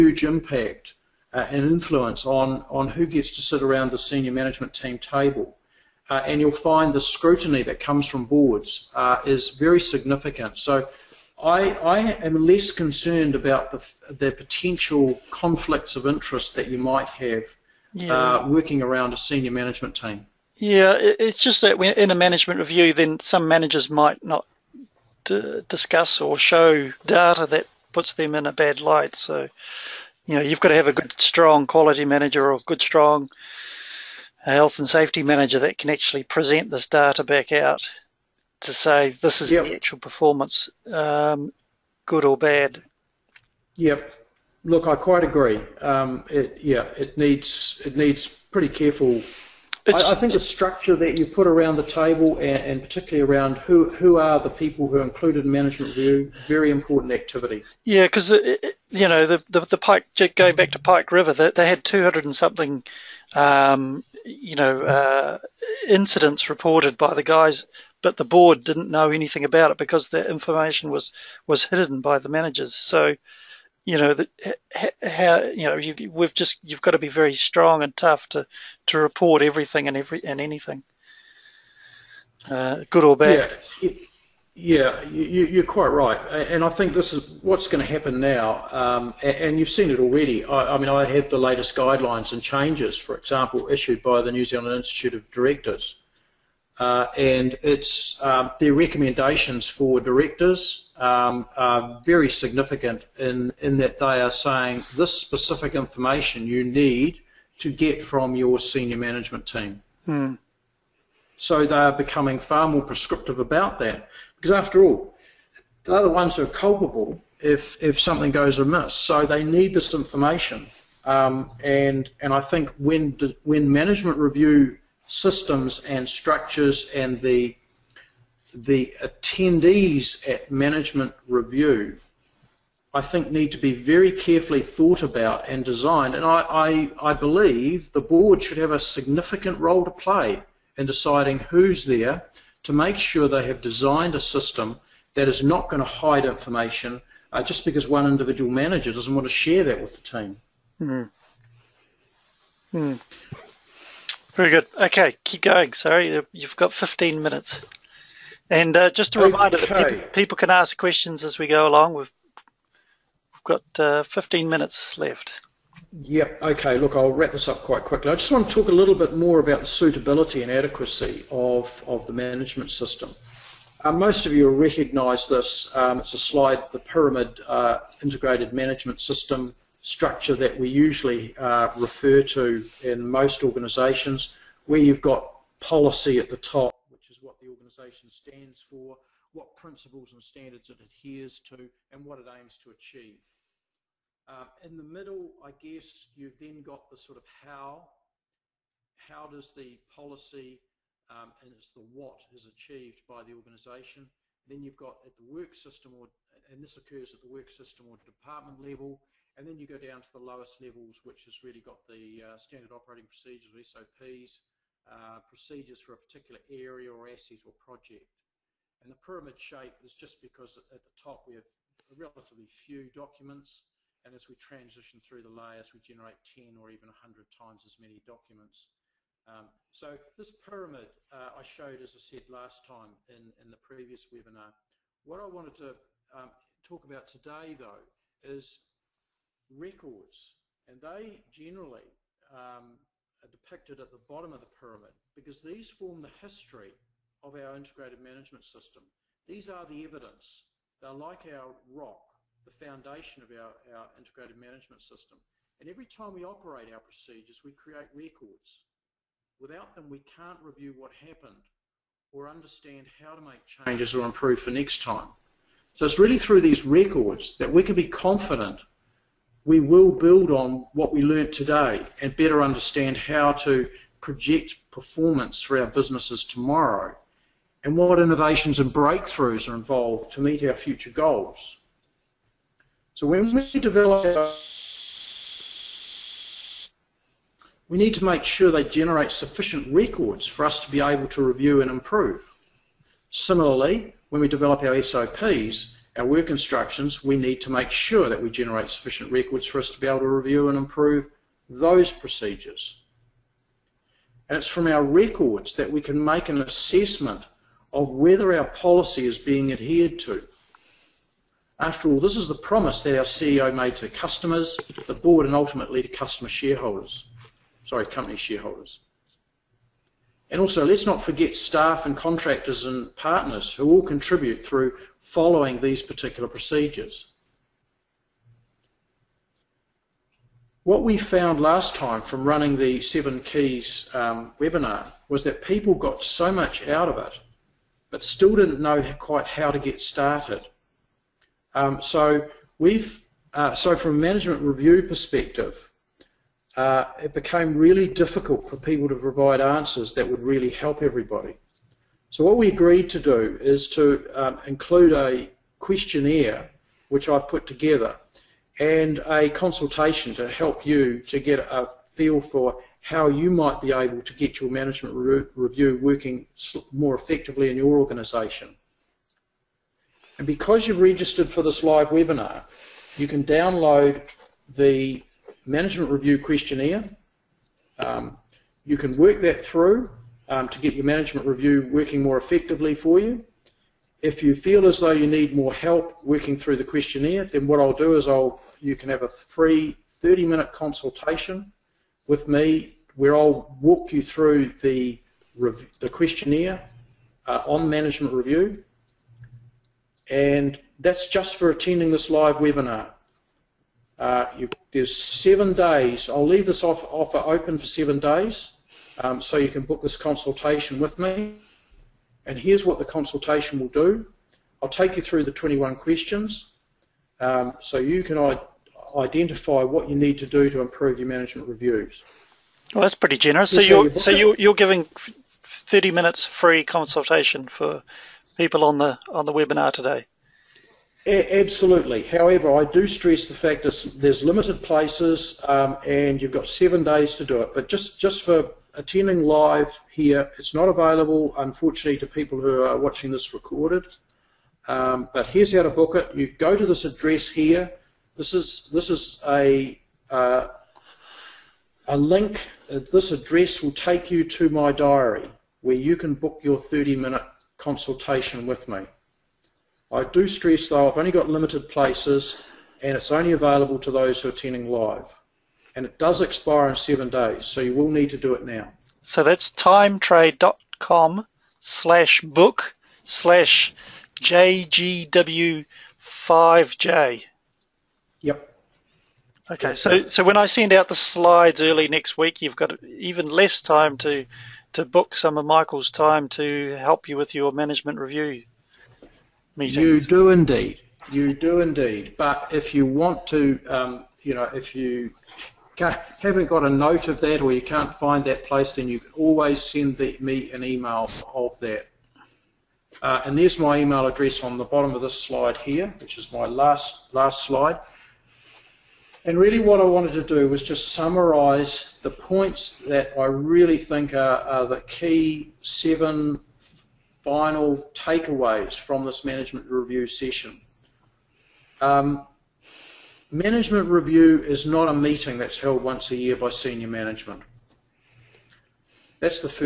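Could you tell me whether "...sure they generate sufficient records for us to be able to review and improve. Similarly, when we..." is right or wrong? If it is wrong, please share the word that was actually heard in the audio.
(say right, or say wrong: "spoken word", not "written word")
right.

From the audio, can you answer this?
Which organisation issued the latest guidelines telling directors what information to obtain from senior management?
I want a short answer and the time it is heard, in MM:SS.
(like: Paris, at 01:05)
New Zealand Institute of Directors, at 01:34.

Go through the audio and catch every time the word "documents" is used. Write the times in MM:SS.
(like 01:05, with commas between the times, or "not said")
03:42, 03:47.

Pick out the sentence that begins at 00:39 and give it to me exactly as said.
the actual performance, um, good or bad.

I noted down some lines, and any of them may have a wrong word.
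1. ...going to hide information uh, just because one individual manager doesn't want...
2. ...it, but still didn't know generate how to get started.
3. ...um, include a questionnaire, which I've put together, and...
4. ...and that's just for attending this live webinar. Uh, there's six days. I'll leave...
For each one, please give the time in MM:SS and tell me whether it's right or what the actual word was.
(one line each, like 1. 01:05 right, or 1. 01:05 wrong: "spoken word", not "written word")
1. 02:25 right
2. 05:36 wrong: "quite", not "generate"
3. 05:54 right
4. 06:40 wrong: "seven", not "six".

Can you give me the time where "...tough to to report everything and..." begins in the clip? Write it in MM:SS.
01:17.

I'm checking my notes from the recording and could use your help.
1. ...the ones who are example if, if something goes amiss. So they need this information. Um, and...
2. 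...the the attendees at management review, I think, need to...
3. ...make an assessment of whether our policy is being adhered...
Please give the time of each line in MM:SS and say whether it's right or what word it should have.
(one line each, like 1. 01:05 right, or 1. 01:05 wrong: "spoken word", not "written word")
1. 01:56 wrong: "culpable", not "example"
2. 02:07 right
3. 05:06 right.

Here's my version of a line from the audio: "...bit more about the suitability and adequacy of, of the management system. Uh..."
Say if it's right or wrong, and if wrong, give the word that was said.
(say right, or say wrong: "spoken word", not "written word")
right.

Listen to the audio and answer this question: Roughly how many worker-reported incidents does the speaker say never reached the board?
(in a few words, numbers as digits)
200 and something.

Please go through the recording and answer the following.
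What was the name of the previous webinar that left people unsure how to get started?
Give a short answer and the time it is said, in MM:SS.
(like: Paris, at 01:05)
Seven Keys, at 05:32.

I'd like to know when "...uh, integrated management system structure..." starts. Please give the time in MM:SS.
02:57.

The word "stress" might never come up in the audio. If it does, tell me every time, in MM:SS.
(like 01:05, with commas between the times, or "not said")
07:12, 07:40.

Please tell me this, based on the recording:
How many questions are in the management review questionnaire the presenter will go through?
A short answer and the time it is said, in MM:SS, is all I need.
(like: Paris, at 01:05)
21, at 06:55.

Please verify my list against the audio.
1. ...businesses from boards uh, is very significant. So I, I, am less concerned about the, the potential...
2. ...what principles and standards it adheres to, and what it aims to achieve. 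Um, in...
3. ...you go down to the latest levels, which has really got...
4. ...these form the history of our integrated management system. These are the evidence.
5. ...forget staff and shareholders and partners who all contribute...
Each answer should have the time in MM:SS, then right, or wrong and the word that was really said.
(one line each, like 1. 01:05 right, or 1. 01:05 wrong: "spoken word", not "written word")
1. 00:07 wrong: "comes", not "businesses"
2. 03:09 right
3. 03:29 wrong: "lowest", not "latest"
4. 04:05 right
5. 05:21 wrong: "contractors", not "shareholders".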